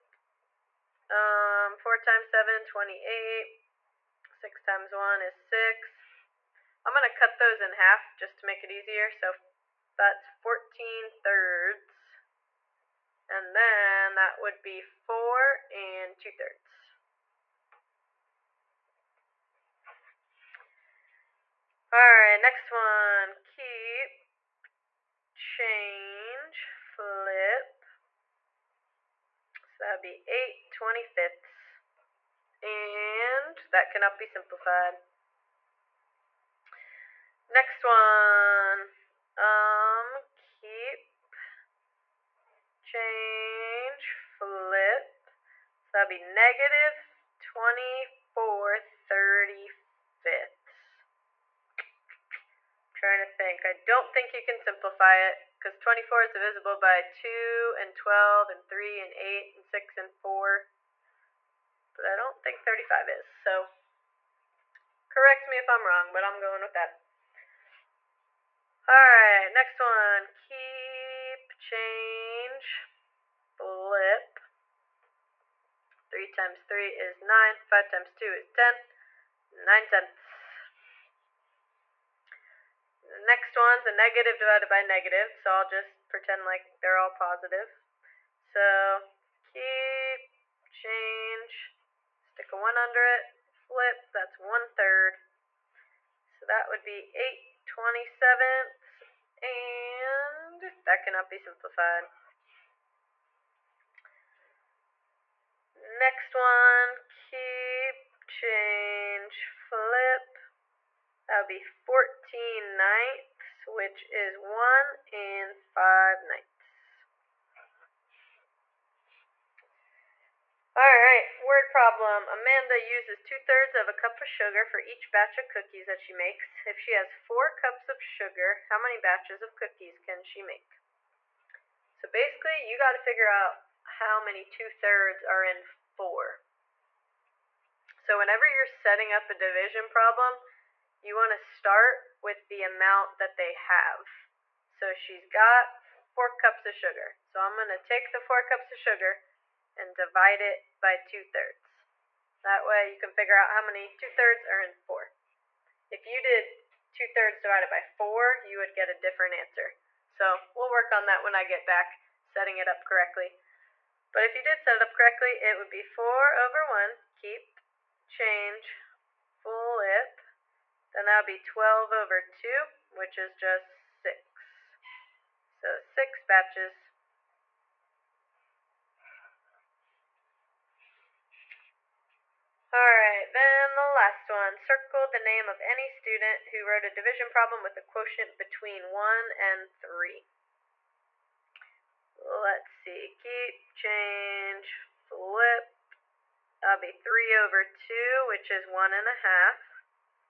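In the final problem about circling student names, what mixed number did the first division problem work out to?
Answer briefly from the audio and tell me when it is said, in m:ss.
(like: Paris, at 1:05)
1 1/2, at 3:18.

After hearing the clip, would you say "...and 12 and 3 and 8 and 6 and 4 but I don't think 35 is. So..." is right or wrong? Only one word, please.
right.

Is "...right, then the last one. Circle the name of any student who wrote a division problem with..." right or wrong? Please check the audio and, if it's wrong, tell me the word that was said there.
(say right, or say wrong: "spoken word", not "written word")
right.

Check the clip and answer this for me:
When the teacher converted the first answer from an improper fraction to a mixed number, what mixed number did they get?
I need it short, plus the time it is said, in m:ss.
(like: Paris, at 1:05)
4 2/3, at 0:14.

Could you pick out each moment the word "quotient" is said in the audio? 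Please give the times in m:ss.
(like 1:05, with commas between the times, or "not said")
3:07.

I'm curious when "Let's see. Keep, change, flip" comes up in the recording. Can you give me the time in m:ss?
3:12.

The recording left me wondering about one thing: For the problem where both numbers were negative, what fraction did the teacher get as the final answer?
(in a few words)
8/27.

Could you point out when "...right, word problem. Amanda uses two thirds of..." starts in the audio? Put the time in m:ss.
2:00.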